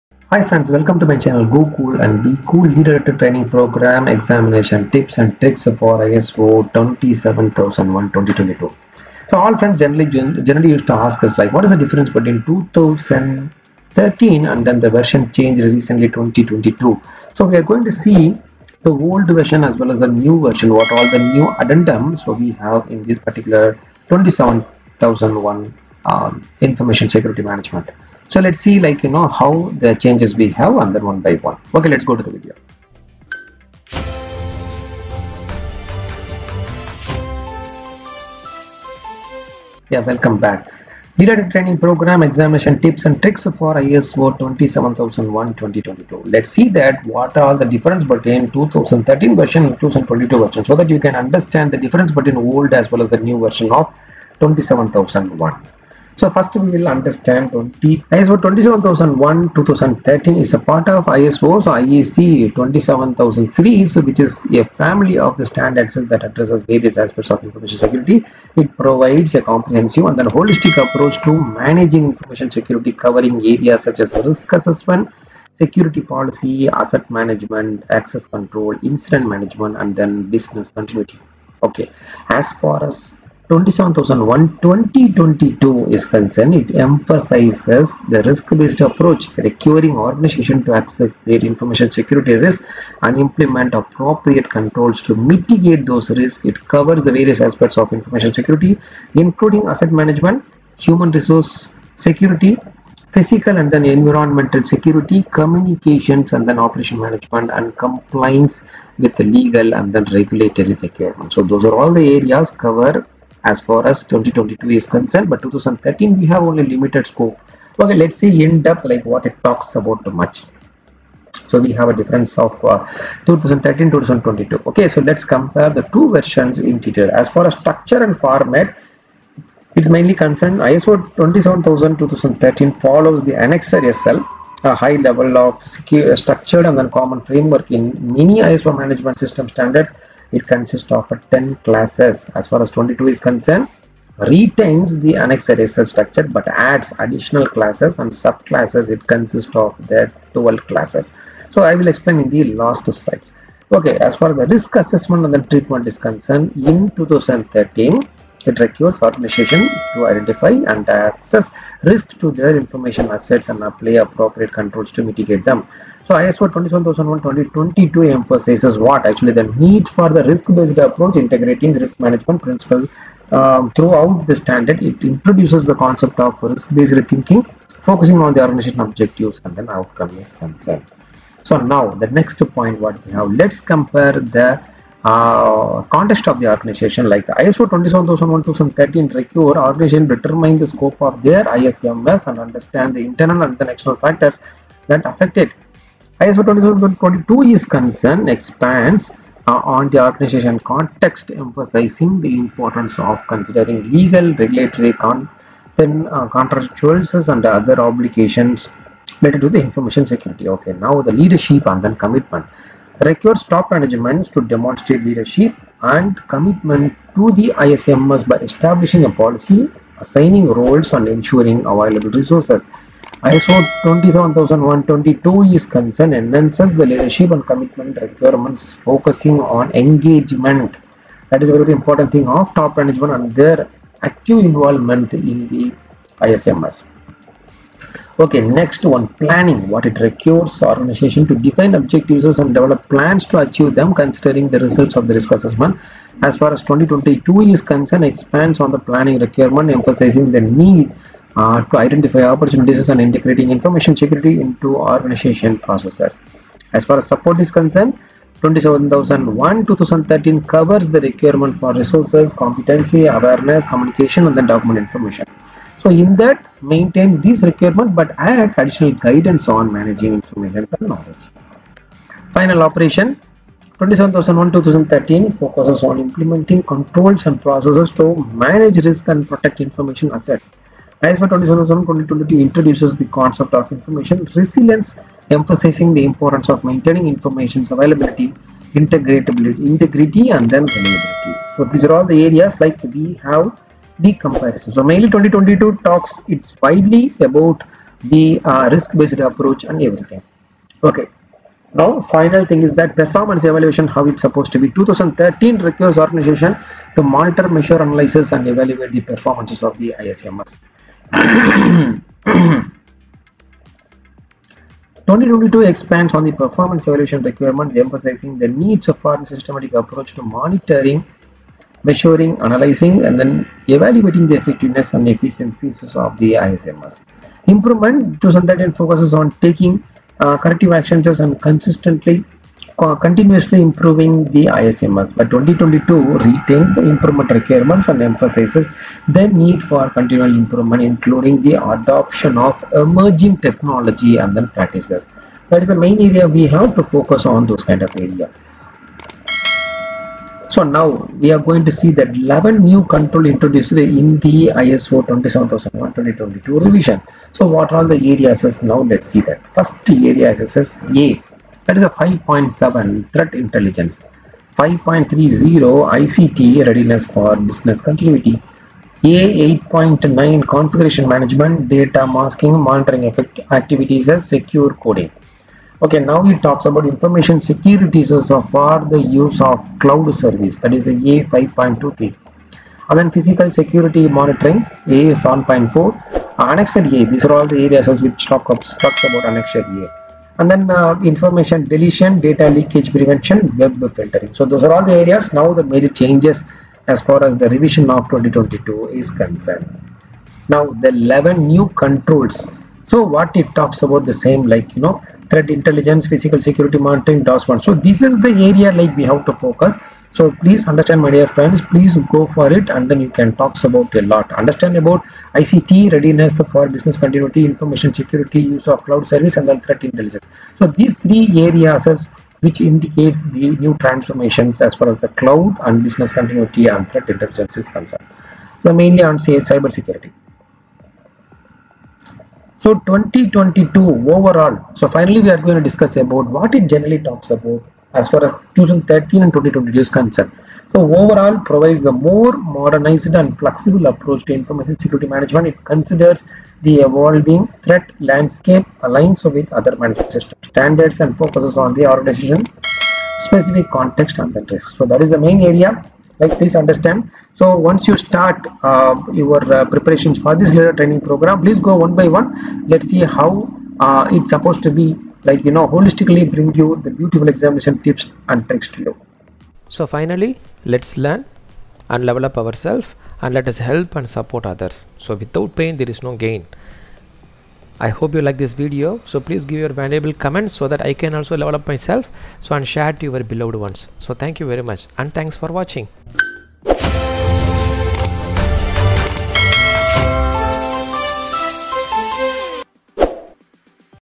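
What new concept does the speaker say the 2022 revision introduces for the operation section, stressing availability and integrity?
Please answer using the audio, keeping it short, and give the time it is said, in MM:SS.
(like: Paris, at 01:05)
information resilience, at 04:43.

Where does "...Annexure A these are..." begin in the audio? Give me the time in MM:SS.
06:26.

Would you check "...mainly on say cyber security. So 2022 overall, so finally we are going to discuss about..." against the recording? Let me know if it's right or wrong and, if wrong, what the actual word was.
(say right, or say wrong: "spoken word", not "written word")
right.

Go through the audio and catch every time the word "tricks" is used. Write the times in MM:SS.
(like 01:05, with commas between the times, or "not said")
00:05, 00:43, 07:48.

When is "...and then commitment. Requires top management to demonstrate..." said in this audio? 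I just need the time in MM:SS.
03:31.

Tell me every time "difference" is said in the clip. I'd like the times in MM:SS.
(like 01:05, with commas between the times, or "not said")
00:11, 00:47, 00:51, 02:01.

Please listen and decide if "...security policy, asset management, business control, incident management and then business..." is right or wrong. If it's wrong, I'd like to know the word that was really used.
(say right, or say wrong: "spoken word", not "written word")
wrong: "access", not "business".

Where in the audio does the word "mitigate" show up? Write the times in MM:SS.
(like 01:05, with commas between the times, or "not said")
01:35, 02:45.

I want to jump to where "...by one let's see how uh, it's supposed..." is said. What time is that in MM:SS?
07:41.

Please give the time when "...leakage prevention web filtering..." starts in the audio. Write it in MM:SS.
06:32.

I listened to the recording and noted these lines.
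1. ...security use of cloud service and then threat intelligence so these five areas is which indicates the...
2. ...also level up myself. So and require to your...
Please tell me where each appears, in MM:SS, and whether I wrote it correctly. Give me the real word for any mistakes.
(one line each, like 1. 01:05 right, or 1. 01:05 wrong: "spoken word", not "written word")
1. 06:58 wrong: "three", not "five"
2. 08:01 wrong: "share", not "require".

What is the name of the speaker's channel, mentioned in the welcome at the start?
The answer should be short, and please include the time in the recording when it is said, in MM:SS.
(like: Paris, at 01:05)
Go Cool and Be Cool, at 00:01.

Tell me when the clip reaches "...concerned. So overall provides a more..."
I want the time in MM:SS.
07:19.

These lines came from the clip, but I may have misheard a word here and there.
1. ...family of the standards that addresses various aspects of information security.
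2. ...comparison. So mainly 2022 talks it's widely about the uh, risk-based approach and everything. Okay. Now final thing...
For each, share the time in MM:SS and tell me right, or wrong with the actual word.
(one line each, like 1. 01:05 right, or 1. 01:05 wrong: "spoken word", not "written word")
1. 01:04 right
2. 04:54 right.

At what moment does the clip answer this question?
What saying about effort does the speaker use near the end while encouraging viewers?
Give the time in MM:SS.
07:55.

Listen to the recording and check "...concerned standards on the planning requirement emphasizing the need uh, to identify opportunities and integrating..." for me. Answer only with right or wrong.
wrong.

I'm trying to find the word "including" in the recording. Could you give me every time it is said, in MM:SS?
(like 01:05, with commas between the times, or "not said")
01:39, 05:40.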